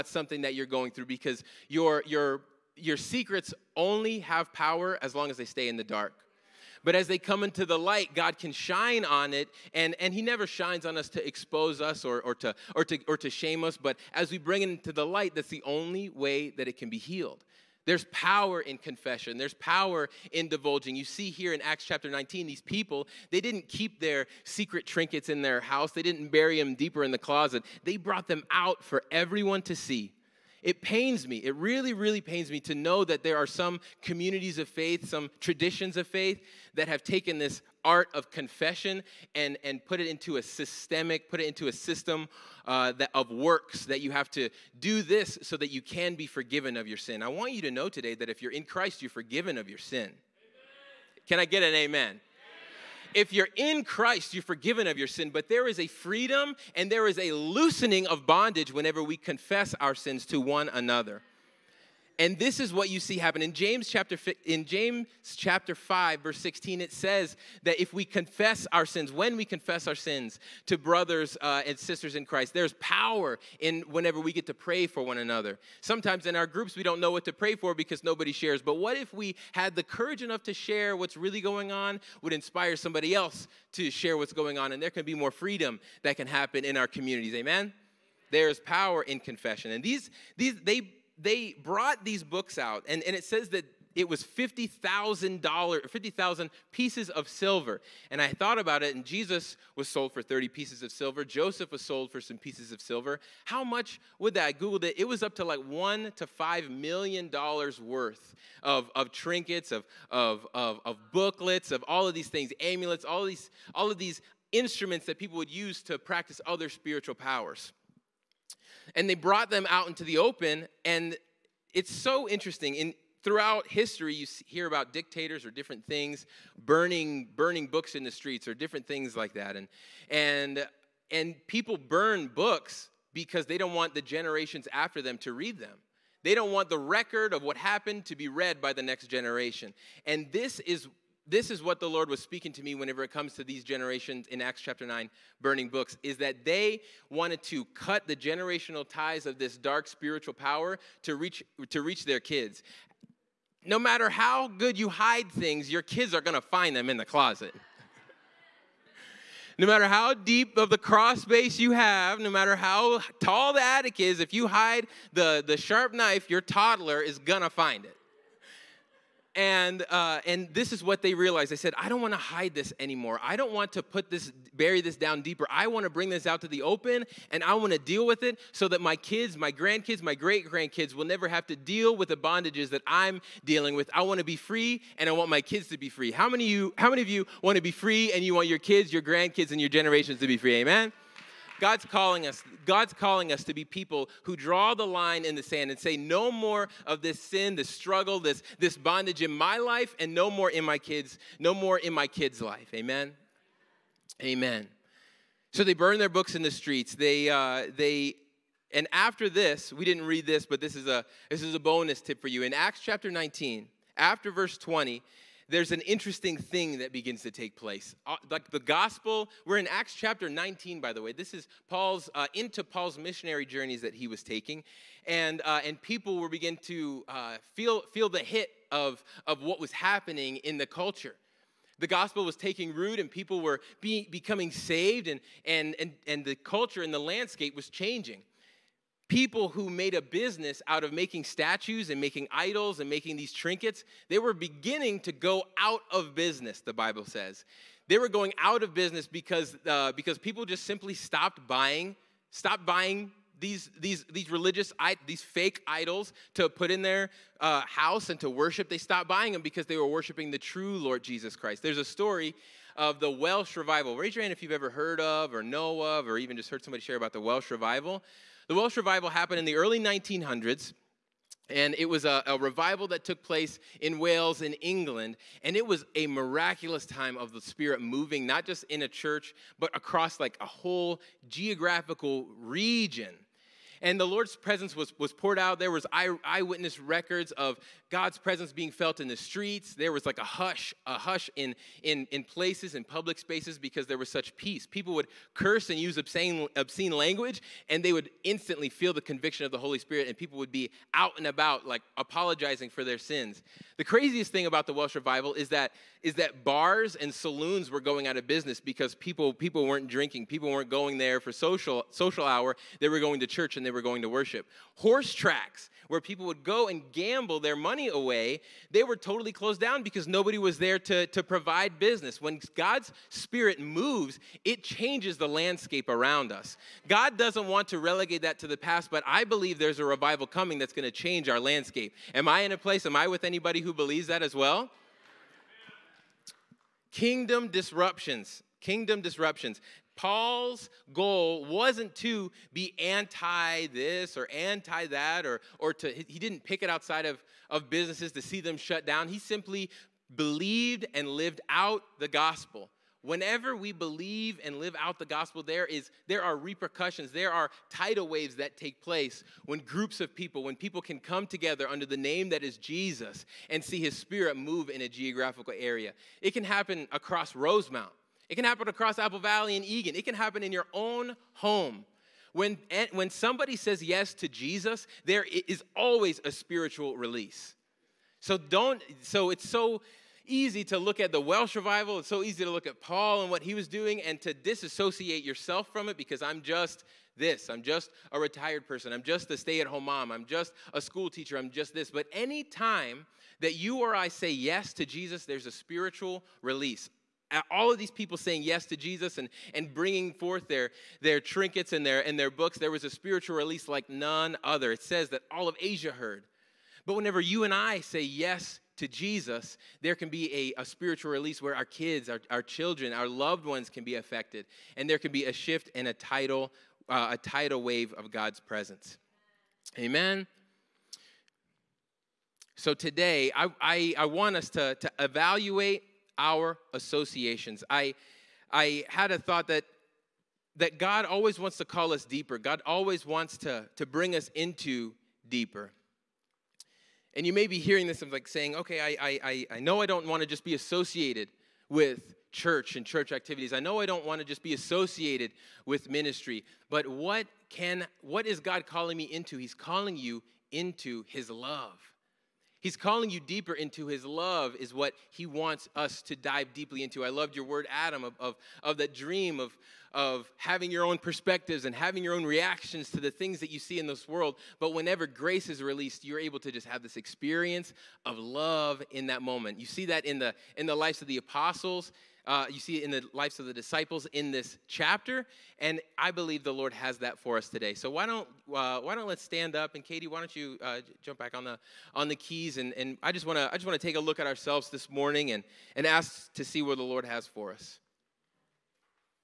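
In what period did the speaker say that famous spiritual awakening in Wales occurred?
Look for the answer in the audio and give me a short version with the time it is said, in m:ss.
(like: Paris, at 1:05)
early 1900s, at 4:29.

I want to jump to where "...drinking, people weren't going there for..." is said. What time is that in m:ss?
5:09.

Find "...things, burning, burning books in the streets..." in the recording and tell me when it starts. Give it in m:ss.
2:05.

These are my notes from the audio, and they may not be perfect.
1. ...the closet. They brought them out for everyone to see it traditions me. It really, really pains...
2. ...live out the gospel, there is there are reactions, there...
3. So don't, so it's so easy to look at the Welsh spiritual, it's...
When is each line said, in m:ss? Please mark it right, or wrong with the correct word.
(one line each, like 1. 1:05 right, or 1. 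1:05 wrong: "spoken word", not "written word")
1. 0:27 wrong: "pains", not "traditions"
2. 5:54 wrong: "repercussions", not "reactions"
3. 6:18 wrong: "revival", not "spiritual".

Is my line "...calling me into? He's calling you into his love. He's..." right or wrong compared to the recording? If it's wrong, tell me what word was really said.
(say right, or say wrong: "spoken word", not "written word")
right.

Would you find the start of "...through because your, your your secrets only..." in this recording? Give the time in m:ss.
0:00.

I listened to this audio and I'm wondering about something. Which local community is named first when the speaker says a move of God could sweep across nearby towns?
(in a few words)
Rosemount.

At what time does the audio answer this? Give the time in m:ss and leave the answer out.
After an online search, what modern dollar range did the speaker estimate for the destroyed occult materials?
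1:45.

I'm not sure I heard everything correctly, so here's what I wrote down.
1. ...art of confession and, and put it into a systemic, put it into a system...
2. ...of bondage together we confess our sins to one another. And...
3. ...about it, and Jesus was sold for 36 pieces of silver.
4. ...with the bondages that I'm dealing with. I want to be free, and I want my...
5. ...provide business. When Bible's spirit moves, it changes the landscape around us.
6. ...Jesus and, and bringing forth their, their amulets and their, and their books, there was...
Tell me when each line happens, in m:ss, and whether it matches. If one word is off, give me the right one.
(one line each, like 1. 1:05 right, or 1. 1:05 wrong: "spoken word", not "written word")
1. 0:37 right
2. 0:58 wrong: "whenever", not "together"
3. 1:38 wrong: "30", not "36"
4. 3:01 right
5. 5:21 wrong: "God", not "Bible"
6. 6:38 wrong: "trinkets", not "amulets".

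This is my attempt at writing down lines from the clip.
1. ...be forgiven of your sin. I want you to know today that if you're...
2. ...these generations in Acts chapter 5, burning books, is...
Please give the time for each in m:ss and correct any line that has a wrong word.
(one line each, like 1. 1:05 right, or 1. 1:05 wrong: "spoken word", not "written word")
1. 0:46 right
2. 2:23 wrong: "9", not "5".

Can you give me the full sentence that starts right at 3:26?
They uh, they and after this, we didn't read this, but this is a this is a bonus tip for you.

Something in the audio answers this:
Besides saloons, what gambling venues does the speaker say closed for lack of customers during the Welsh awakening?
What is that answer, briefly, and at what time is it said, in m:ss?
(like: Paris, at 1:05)
Horse tracks, at 5:14.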